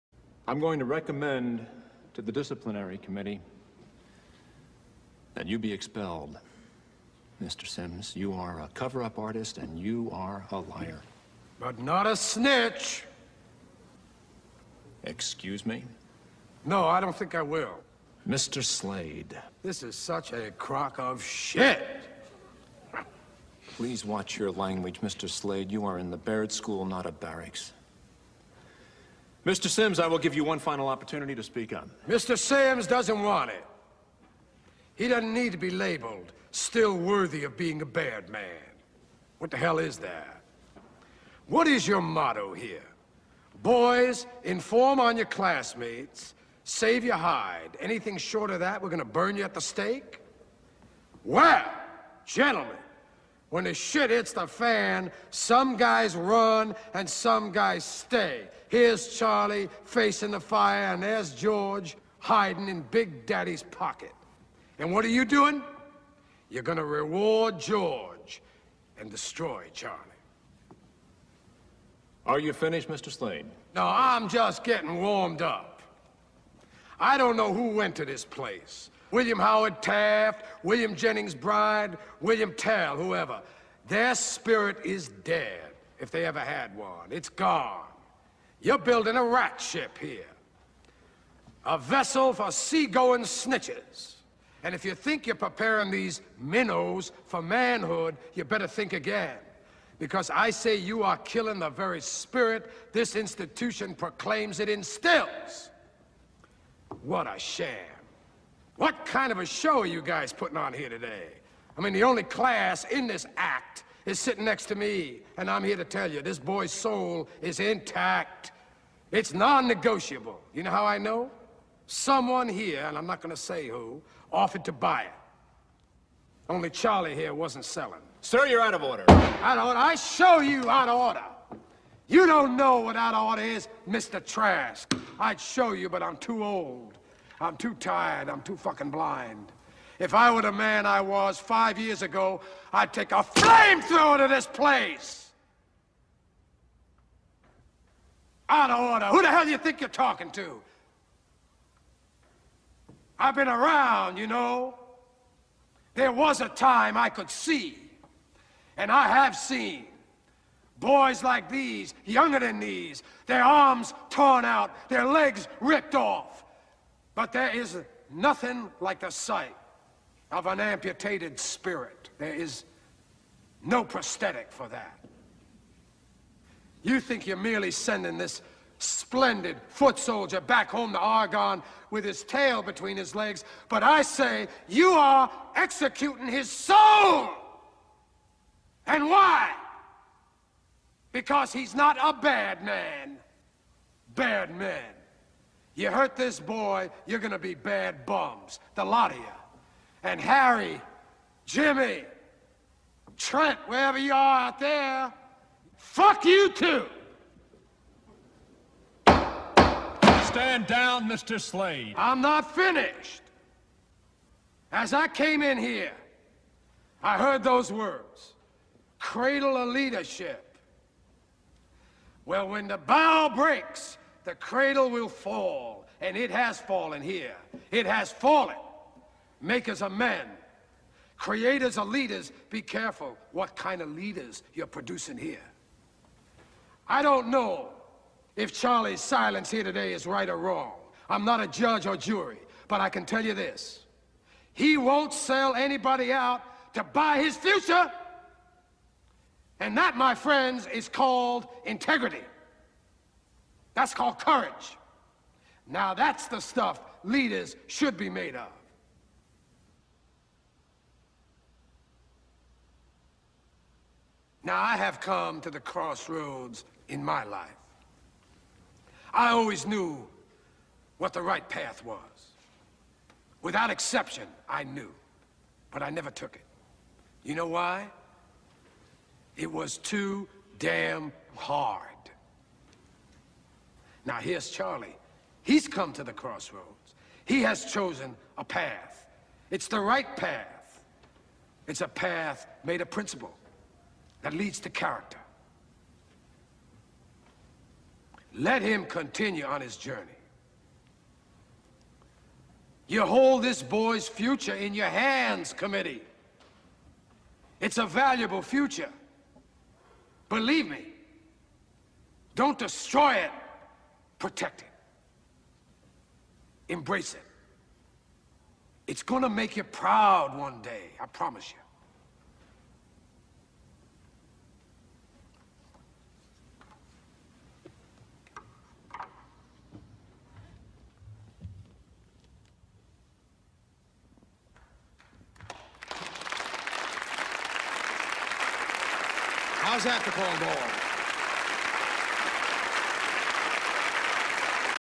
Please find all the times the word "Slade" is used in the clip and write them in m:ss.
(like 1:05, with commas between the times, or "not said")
0:18, 0:25, 1:13, 3:31.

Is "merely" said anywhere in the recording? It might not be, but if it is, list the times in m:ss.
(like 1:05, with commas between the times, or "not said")
2:57.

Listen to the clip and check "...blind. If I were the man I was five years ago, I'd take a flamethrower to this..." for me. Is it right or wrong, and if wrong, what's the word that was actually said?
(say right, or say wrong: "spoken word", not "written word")
right.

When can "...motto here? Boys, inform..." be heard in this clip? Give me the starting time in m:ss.
0:42.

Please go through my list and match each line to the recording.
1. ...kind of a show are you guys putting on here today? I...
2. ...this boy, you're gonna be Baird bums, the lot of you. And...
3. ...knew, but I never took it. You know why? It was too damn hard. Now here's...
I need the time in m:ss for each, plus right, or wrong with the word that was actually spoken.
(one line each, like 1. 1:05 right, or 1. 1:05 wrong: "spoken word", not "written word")
1. 1:49 right
2. 3:16 right
3. 4:34 right.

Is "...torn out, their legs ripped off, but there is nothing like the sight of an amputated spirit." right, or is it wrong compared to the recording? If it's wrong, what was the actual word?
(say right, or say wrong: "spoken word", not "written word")
right.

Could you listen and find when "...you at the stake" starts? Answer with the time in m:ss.
0:49.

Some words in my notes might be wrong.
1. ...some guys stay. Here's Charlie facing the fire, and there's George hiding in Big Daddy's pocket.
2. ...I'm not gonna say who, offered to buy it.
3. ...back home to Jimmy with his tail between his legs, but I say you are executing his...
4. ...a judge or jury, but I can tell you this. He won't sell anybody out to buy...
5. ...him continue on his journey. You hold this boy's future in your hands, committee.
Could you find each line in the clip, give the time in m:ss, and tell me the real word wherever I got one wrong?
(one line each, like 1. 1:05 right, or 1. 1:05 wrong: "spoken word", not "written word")
1. 0:57 right
2. 2:02 right
3. 3:00 wrong: "Oregon", not "Jimmy"
4. 4:01 right
5. 4:58 right.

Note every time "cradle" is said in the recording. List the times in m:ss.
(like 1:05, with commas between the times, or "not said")
3:38, 3:44.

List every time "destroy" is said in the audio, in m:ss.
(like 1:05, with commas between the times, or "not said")
1:09, 5:12.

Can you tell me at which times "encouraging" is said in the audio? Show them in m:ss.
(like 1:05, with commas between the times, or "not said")
not said.